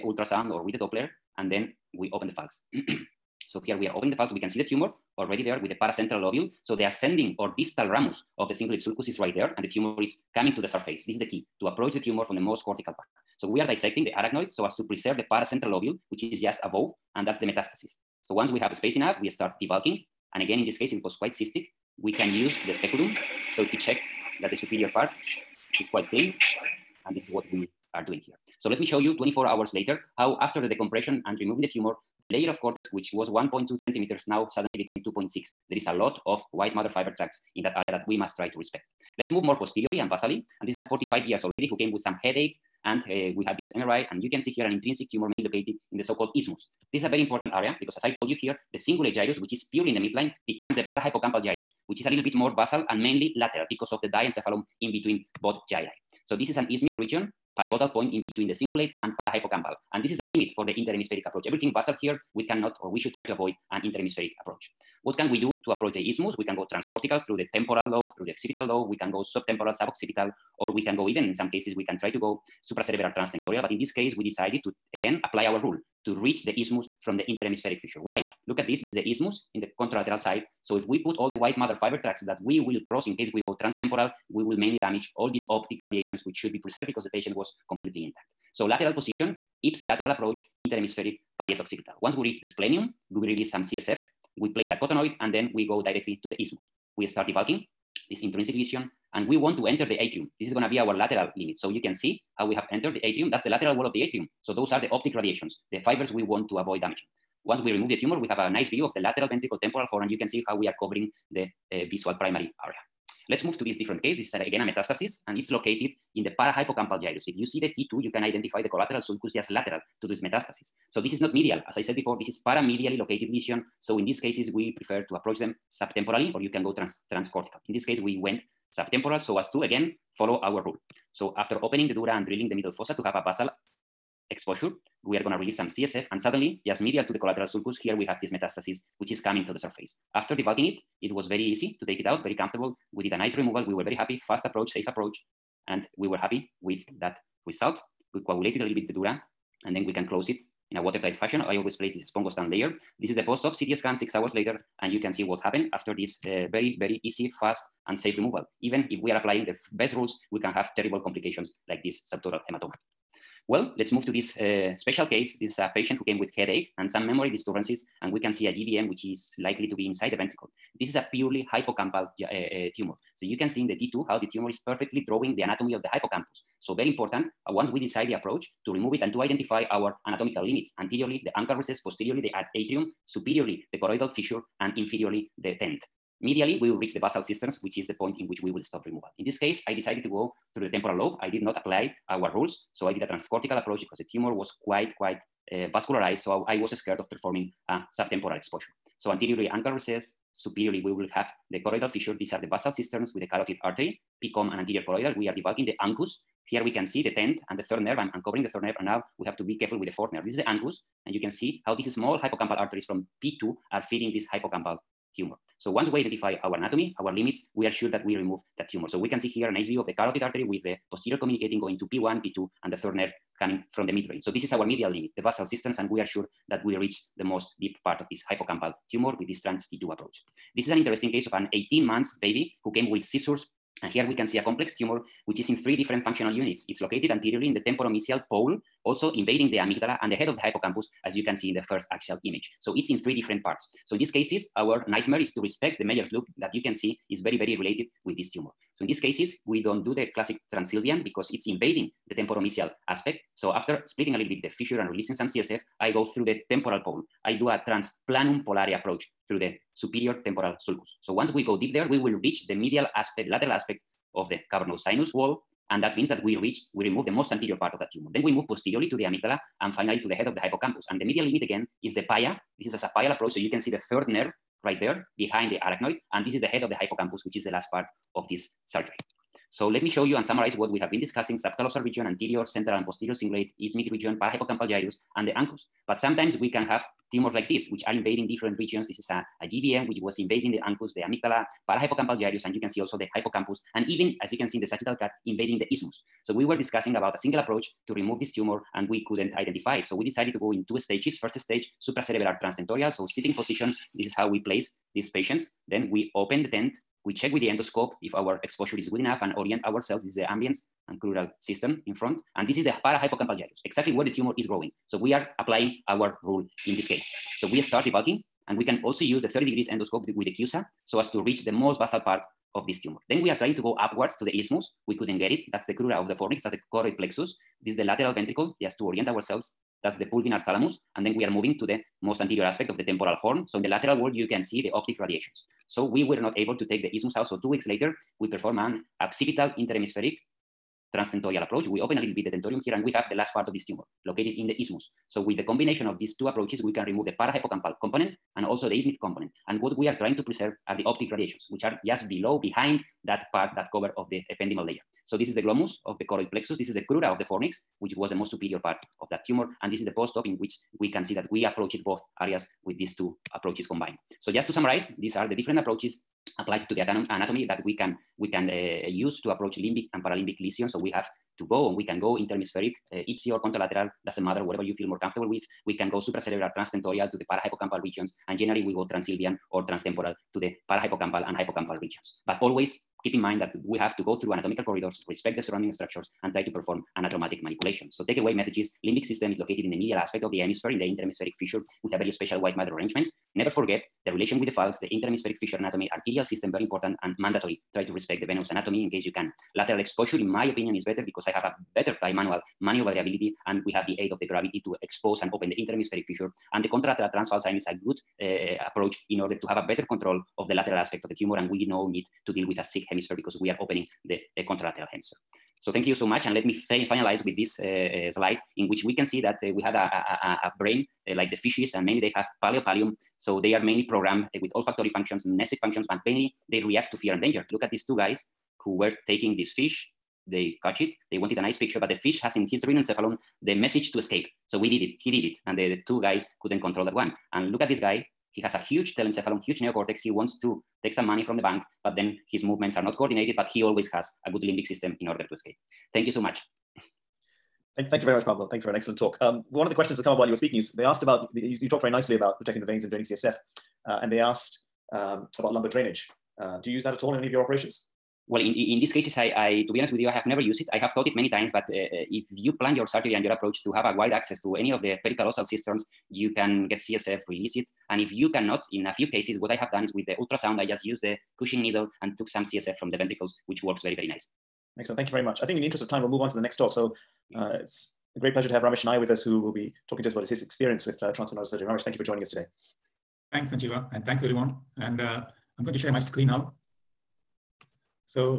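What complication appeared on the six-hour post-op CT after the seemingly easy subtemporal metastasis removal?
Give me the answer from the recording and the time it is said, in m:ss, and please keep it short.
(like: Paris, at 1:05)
subdural hematoma, at 2:42.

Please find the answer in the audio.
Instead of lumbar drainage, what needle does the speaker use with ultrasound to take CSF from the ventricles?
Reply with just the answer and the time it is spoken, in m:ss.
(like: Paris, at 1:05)
Cushing needle, at 7:51.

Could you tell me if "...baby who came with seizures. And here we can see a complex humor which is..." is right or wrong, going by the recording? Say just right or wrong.
wrong.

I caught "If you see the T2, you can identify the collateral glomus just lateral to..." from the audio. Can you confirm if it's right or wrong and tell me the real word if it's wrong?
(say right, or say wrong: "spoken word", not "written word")
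wrong: "sulcus", not "glomus".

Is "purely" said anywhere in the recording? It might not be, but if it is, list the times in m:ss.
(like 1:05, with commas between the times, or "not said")
0:49, 2:51.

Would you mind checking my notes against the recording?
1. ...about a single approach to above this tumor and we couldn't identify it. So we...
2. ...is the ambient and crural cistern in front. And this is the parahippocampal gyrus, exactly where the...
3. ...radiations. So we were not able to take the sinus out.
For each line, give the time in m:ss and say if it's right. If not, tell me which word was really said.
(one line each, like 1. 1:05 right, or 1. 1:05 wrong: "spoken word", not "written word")
1. 4:56 wrong: "remove", not "above"
2. 5:10 right
3. 5:34 wrong: "isthmus", not "sinus".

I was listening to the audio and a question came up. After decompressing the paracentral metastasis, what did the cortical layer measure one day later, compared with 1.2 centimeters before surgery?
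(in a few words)
2.6 centimeters.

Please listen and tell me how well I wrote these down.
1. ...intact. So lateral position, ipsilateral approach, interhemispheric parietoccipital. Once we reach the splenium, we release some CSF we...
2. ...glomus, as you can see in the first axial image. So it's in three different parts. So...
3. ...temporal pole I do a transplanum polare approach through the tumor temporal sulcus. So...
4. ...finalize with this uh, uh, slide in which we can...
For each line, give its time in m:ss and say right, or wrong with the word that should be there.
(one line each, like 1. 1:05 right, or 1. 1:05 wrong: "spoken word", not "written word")
1. 1:28 right
2. 4:00 wrong: "hippocampus", not "glomus"
3. 4:16 wrong: "superior", not "tumor"
4. 6:56 right.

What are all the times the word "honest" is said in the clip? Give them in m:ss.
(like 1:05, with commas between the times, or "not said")
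7:39.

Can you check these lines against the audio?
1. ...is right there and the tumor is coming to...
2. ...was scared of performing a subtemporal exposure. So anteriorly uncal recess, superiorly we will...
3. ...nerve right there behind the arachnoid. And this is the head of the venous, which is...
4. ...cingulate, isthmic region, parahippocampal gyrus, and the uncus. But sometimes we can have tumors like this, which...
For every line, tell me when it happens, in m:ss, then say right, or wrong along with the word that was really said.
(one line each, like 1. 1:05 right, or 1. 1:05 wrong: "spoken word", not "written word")
1. 0:09 right
2. 3:16 right
3. 4:34 wrong: "hippocampus", not "venous"
4. 4:43 right.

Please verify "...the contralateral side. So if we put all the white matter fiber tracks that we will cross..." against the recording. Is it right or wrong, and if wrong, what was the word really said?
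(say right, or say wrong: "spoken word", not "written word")
right.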